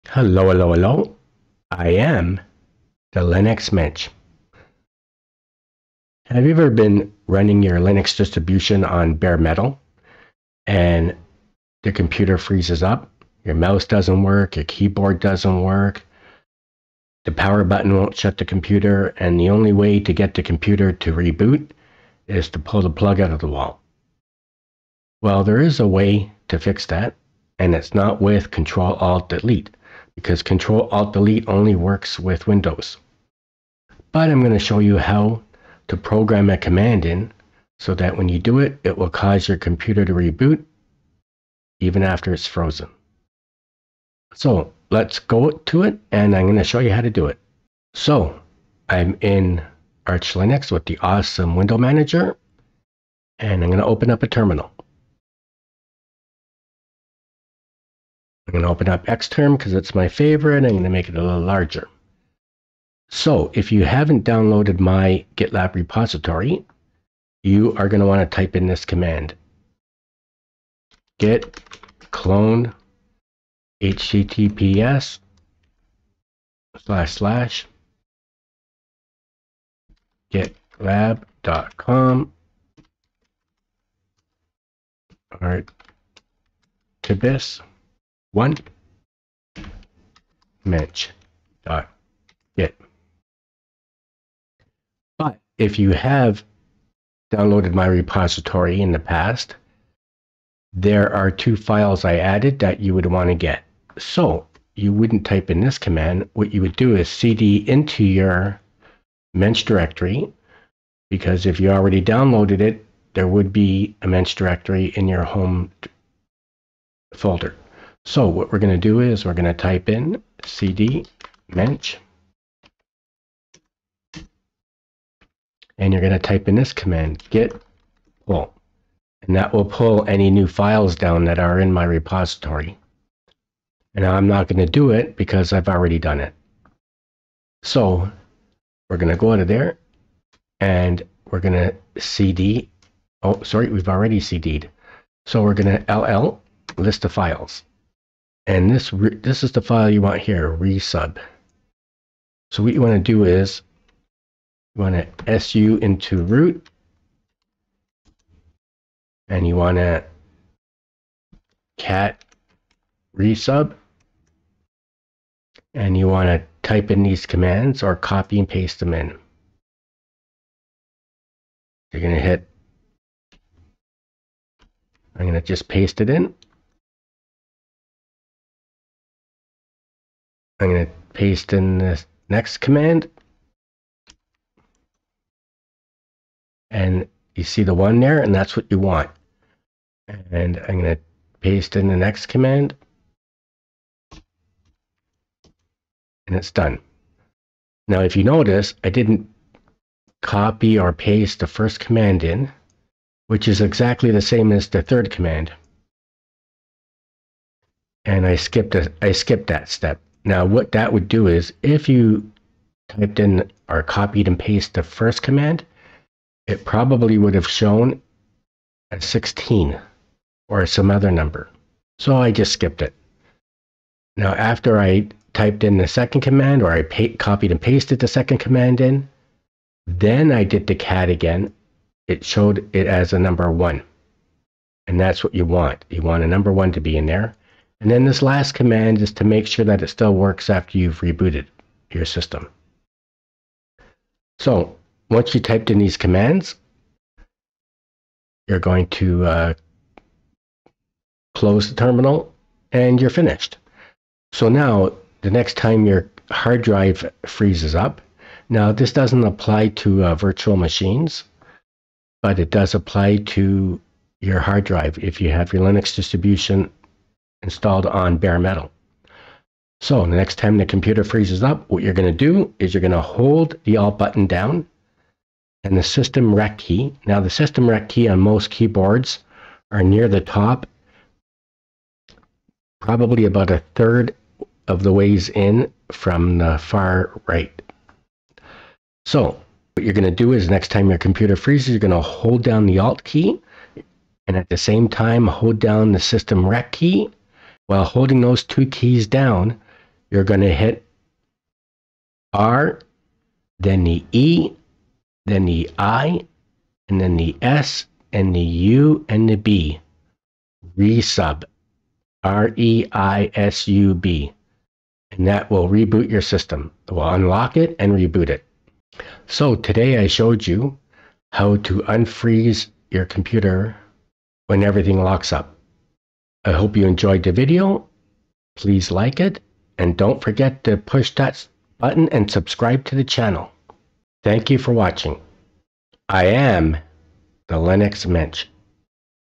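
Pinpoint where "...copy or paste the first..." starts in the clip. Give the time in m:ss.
3:20.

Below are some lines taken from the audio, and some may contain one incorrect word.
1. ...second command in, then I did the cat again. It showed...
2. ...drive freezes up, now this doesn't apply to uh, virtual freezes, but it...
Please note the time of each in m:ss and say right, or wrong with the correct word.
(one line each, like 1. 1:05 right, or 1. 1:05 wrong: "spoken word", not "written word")
1. 3:48 right
2. 4:16 wrong: "machines", not "freezes".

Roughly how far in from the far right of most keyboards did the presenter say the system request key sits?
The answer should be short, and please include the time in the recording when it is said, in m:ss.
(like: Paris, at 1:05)
about a third, at 4:43.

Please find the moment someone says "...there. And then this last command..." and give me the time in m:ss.
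3:57.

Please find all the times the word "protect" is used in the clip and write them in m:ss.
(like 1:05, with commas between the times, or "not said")
not said.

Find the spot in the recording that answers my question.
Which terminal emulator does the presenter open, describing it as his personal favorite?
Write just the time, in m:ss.
0:59.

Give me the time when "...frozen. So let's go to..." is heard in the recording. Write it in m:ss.
0:42.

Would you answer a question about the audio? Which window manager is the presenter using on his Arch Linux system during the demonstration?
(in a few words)
awesome.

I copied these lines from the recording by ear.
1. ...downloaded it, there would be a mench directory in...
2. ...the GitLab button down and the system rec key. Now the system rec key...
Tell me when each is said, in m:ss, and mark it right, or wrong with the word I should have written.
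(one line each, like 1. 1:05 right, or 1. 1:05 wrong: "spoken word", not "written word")
1. 1:52 right
2. 4:33 wrong: "Alt", not "GitLab".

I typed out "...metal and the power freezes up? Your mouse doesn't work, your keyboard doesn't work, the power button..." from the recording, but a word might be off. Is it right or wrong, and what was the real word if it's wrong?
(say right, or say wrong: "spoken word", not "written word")
wrong: "computer", not "power".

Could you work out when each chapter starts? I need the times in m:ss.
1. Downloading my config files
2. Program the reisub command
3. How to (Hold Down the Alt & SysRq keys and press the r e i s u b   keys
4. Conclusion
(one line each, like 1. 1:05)
1. 1:00
2. 2:37
3. 4:28
4. 5:18.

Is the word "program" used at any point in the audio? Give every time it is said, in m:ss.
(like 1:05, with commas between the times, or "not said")
0:35.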